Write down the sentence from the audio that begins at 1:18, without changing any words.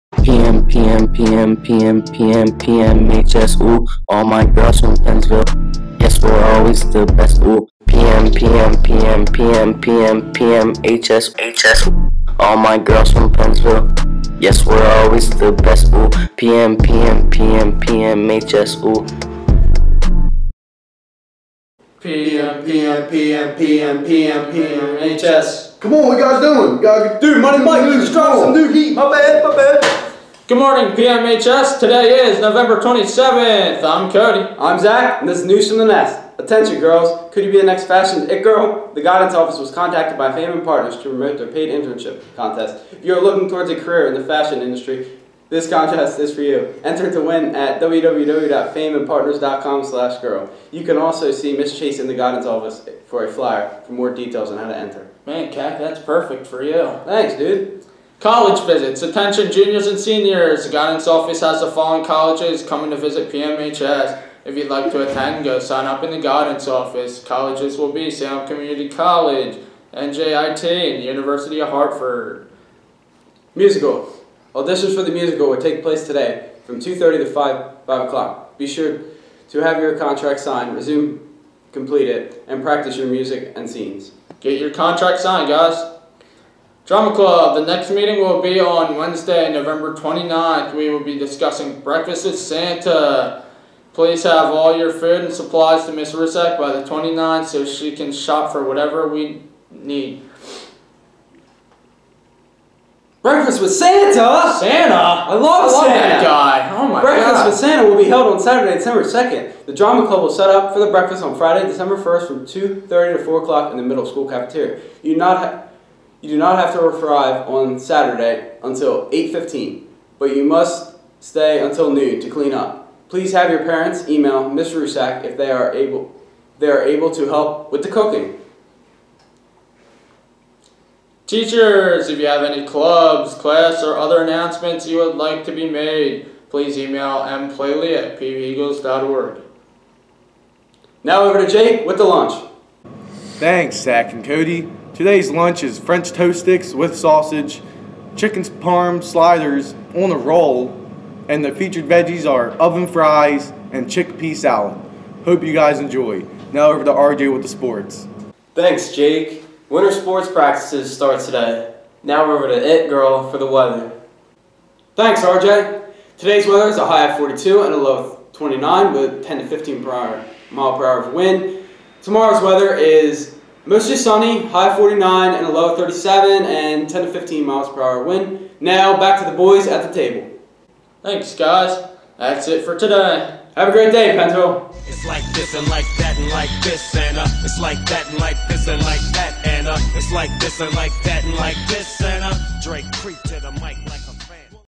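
Be sure to have your contract signed, resume, complete it, and practice your music and scenes.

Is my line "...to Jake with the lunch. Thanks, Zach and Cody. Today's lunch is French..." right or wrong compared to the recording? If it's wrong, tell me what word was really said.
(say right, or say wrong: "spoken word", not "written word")
right.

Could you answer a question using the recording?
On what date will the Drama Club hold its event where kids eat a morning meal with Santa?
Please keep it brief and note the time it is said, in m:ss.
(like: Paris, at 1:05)
December 2nd, at 1:48.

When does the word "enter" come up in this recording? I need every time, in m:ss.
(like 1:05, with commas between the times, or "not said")
0:46, 0:54.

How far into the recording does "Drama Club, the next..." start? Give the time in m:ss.
1:26.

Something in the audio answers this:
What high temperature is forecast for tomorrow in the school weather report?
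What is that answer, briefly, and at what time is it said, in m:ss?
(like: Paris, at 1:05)
49, at 2:54.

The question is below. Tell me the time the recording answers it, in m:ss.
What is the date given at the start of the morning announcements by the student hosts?
0:32.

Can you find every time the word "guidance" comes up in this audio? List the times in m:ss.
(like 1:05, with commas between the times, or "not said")
0:39, 0:52, 1:00, 1:06.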